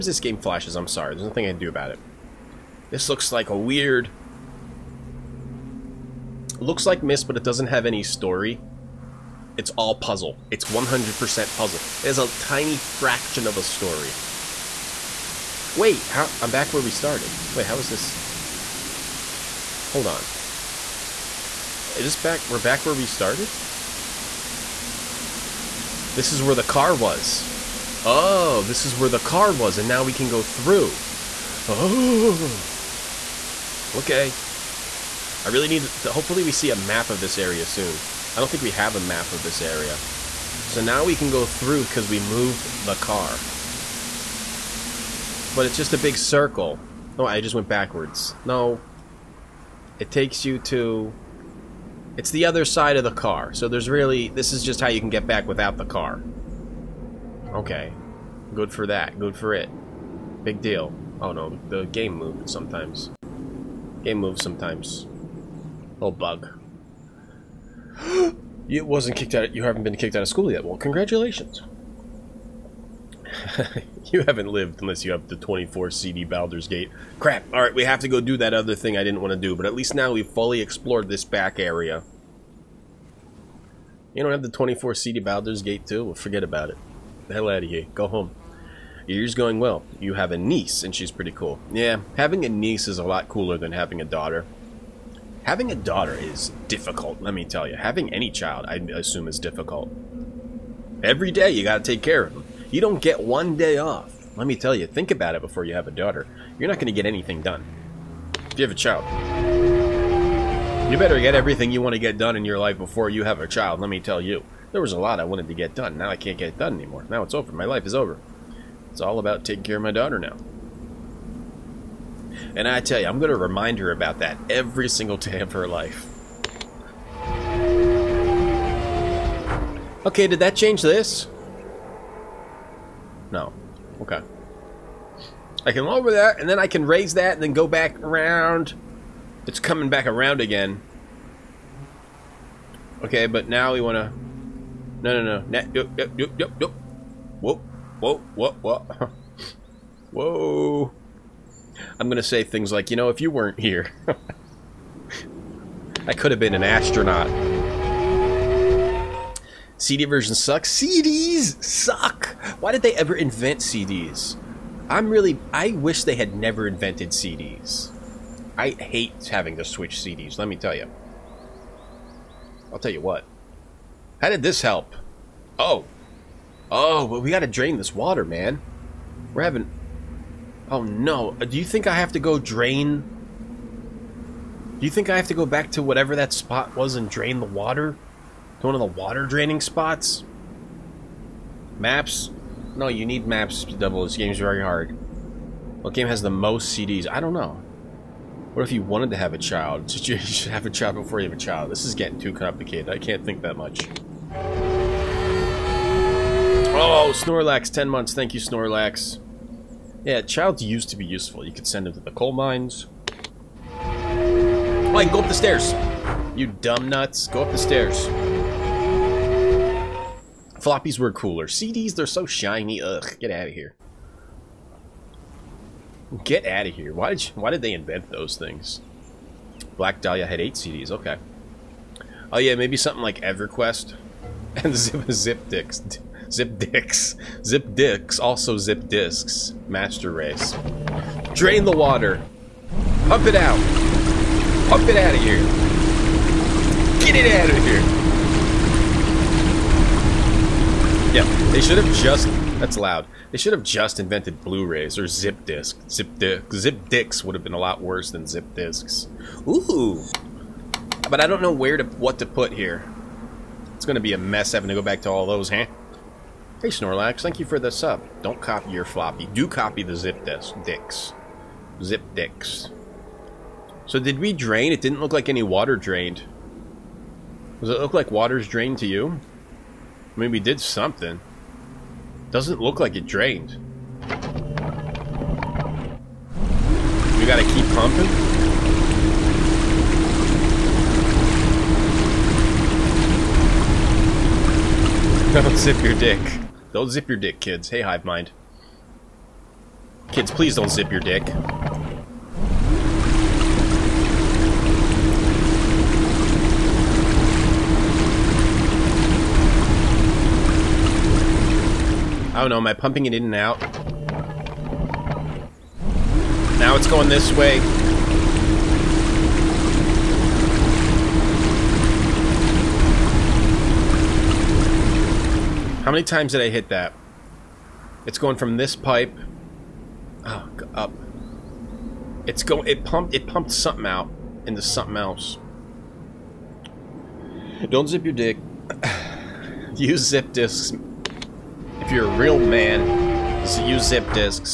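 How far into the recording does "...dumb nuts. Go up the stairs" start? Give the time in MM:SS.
03:36.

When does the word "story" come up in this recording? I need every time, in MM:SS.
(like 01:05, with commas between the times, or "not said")
00:08, 00:13.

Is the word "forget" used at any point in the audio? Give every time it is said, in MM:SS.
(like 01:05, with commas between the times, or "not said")
01:26.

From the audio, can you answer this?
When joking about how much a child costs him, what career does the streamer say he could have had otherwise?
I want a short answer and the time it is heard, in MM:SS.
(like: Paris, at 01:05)
astronaut, at 02:36.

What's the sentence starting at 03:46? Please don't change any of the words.
Why did, you, why did they invent those things?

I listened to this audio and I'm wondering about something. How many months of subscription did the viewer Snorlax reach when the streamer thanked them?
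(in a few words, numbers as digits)
10.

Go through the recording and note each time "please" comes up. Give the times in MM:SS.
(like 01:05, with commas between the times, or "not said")
05:00.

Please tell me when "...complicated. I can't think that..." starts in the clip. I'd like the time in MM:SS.
03:22.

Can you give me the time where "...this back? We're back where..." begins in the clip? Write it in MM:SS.
00:22.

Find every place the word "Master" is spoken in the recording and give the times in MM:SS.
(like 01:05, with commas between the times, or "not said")
03:59.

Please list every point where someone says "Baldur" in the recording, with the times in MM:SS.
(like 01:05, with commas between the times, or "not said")
01:16, 01:25.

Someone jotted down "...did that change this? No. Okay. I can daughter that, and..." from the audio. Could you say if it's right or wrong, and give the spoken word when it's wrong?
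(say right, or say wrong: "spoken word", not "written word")
wrong: "lower", not "daughter".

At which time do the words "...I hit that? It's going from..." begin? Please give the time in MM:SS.
05:26.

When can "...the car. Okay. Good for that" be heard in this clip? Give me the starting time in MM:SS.
00:55.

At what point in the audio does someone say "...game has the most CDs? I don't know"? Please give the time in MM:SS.
03:15.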